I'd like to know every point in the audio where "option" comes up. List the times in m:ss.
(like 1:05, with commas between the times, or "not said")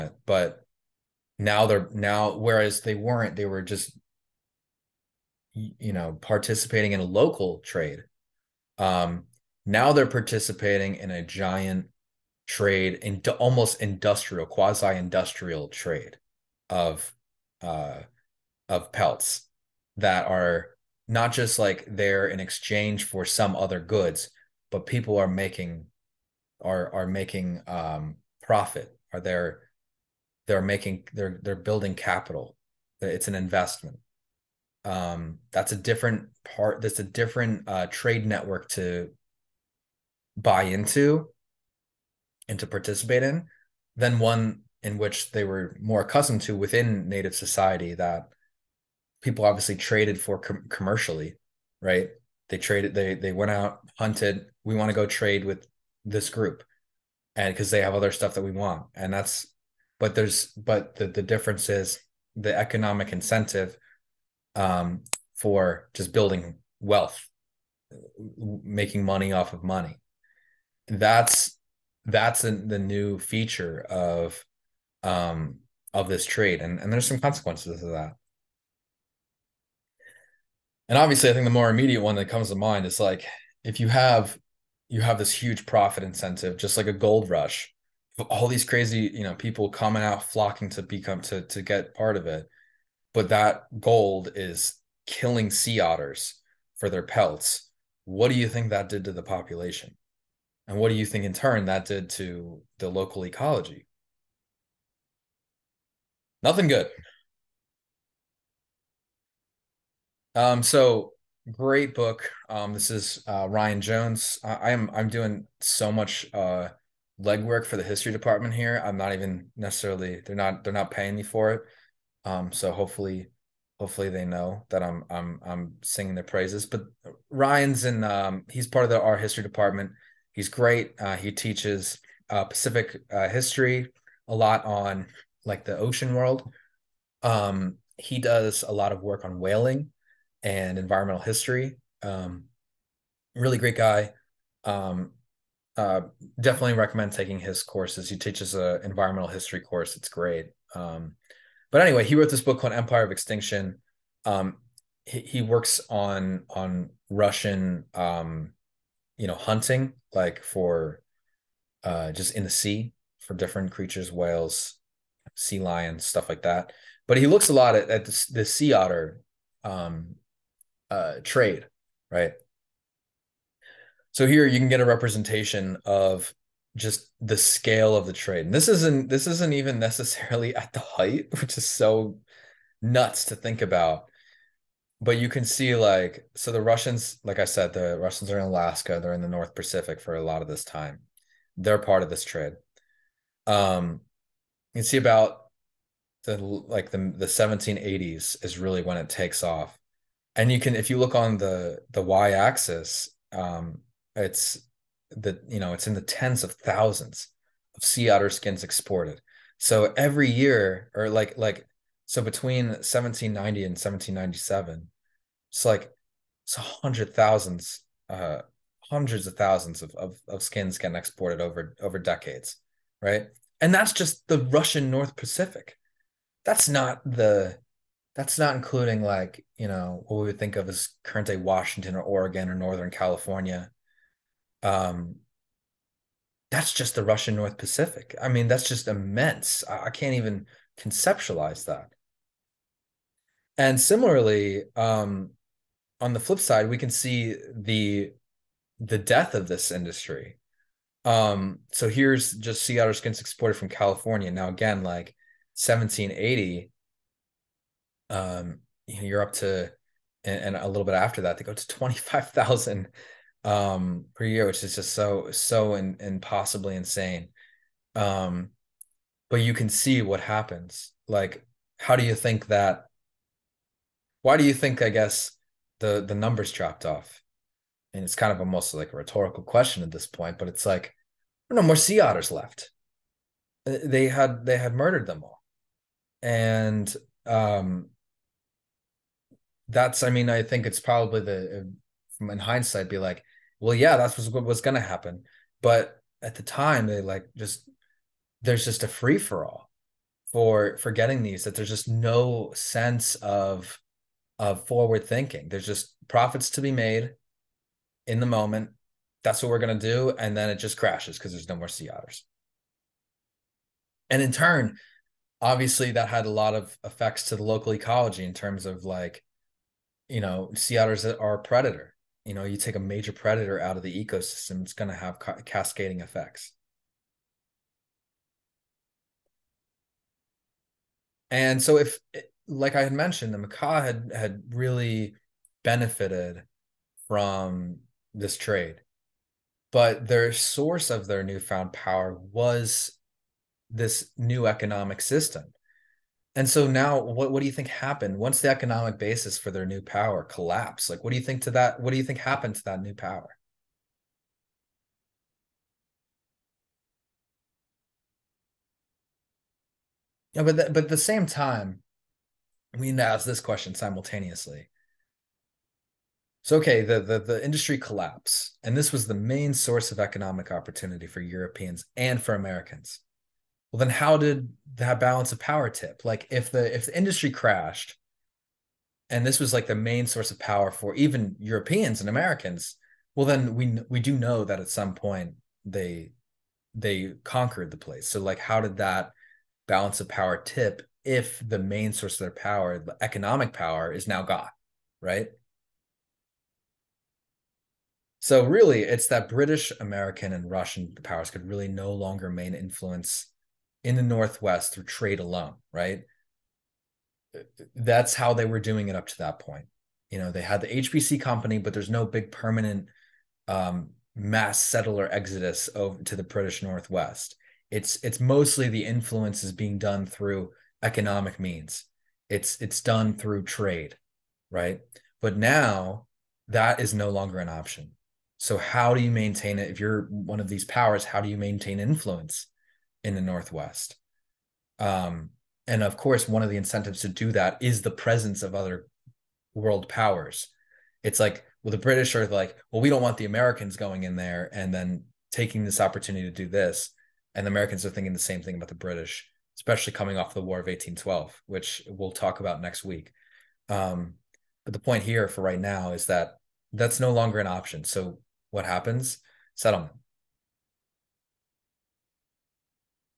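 7:07, 7:37.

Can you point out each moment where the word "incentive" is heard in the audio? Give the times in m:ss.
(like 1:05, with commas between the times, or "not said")
1:03, 1:26, 7:16.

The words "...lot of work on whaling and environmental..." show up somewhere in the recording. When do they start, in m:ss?
2:18.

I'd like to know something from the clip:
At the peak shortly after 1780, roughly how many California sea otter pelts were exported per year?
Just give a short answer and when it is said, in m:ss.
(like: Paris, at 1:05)
25,000, at 4:21.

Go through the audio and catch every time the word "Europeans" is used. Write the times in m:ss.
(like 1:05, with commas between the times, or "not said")
6:11, 6:21.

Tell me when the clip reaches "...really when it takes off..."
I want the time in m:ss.
3:18.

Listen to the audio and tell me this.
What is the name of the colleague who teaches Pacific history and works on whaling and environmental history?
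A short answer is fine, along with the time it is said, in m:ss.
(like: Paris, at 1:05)
Ryan Jones, at 1:53.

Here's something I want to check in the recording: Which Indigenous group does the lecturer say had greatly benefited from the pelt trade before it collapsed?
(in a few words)
Makah.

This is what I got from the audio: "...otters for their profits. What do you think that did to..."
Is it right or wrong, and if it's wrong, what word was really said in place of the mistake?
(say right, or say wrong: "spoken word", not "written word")
wrong: "pelts", not "profits".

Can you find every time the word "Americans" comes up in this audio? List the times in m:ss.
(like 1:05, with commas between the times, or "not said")
6:12, 6:22, 6:39, 7:23, 7:27.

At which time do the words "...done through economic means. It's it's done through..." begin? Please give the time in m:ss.
6:59.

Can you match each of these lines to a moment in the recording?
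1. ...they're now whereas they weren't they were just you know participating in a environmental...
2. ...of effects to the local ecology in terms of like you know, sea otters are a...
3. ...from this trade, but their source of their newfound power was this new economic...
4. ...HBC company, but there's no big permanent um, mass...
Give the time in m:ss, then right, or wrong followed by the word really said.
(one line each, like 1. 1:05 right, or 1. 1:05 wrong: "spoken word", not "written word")
1. 0:01 wrong: "local", not "environmental"
2. 5:16 right
3. 5:37 right
4. 6:50 right.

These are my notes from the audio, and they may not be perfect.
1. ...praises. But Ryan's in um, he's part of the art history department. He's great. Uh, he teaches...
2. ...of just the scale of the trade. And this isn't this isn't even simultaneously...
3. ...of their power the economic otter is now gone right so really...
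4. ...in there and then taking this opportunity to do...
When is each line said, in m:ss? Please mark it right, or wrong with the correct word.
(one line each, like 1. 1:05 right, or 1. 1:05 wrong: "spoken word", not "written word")
1. 2:06 right
2. 2:55 wrong: "necessarily", not "simultaneously"
3. 6:32 wrong: "power", not "otter"
4. 7:24 right.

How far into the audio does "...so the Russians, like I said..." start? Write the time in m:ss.
3:06.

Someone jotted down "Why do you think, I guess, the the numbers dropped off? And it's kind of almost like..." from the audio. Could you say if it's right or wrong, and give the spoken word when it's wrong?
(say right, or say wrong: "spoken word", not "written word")
right.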